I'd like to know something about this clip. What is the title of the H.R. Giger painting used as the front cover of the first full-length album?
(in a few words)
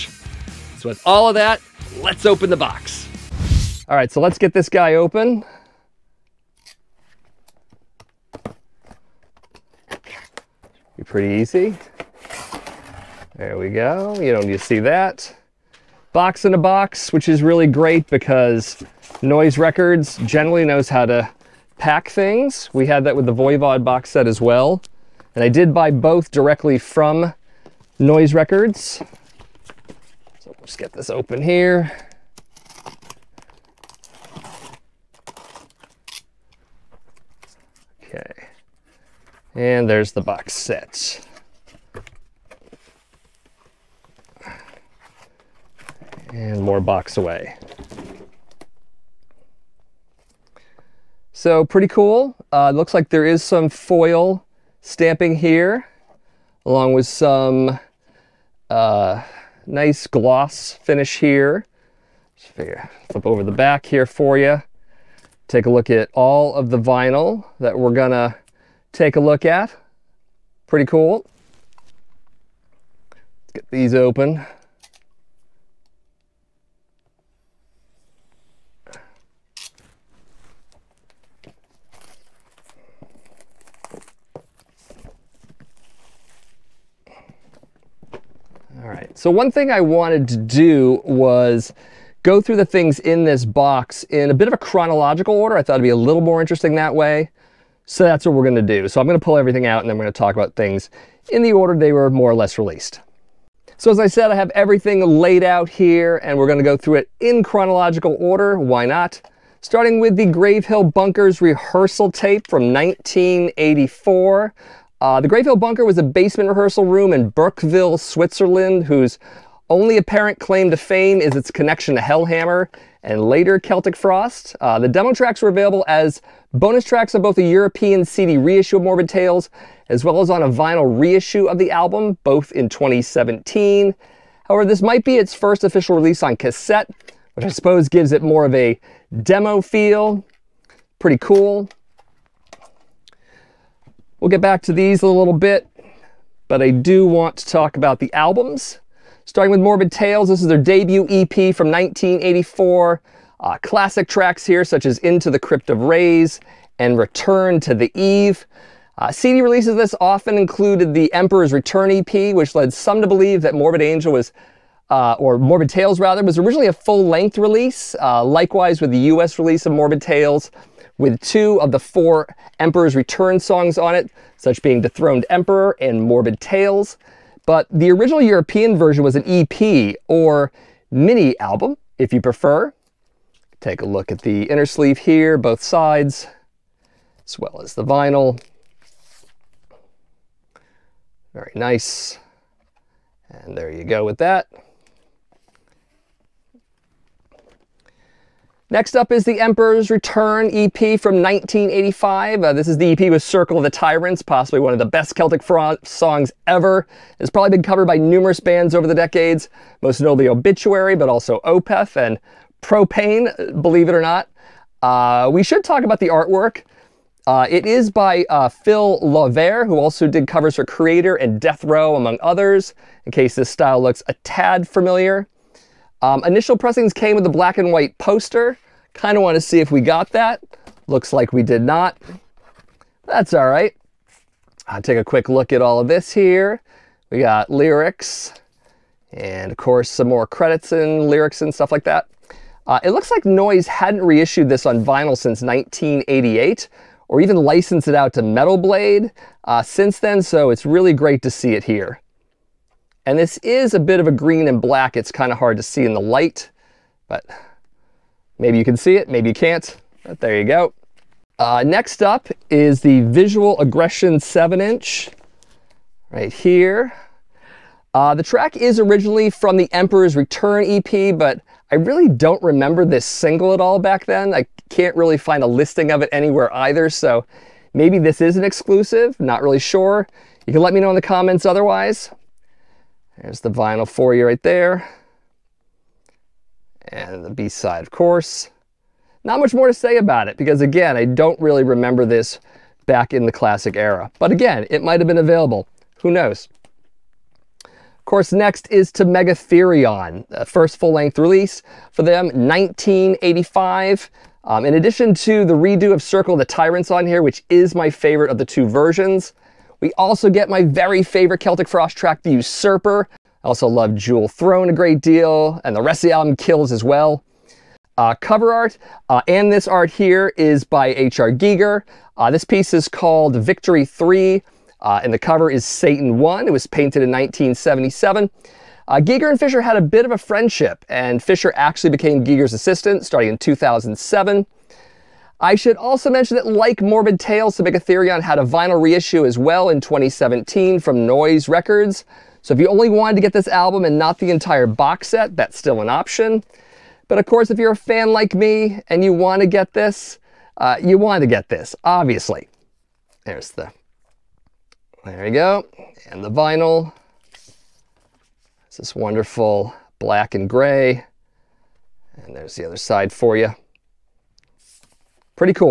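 Satan 1.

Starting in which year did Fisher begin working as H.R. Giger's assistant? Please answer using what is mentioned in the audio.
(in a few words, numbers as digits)
2007.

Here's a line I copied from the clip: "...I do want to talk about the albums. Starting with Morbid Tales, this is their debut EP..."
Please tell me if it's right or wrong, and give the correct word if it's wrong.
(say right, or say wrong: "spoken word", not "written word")
right.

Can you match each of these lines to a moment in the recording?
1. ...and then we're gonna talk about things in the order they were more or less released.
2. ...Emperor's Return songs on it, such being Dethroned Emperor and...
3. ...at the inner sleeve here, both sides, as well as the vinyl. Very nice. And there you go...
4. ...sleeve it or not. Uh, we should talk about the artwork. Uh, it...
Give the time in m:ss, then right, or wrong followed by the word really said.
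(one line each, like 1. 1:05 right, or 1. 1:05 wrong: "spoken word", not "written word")
1. 1:39 right
2. 2:52 right
3. 3:04 right
4. 3:33 wrong: "believe", not "sleeve".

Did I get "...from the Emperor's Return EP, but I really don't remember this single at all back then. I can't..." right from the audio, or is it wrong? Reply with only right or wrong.
right.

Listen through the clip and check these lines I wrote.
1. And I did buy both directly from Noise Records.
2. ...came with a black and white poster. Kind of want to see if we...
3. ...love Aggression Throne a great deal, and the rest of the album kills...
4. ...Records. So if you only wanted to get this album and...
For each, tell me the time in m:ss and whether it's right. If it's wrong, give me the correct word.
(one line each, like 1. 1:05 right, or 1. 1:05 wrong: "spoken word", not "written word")
1. 0:25 right
2. 3:46 right
3. 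5:13 wrong: "Jewel", not "Aggression"
4. 5:41 right.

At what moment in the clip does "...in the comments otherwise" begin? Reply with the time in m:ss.
4:40.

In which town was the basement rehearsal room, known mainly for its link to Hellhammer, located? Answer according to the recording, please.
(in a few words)
Burkeville.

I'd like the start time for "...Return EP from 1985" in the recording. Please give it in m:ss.
3:19.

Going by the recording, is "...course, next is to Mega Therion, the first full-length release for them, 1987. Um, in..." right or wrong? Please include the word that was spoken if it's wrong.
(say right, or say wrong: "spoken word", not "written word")
wrong: "1985", not "1987".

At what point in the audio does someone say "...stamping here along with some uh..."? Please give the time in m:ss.
0:54.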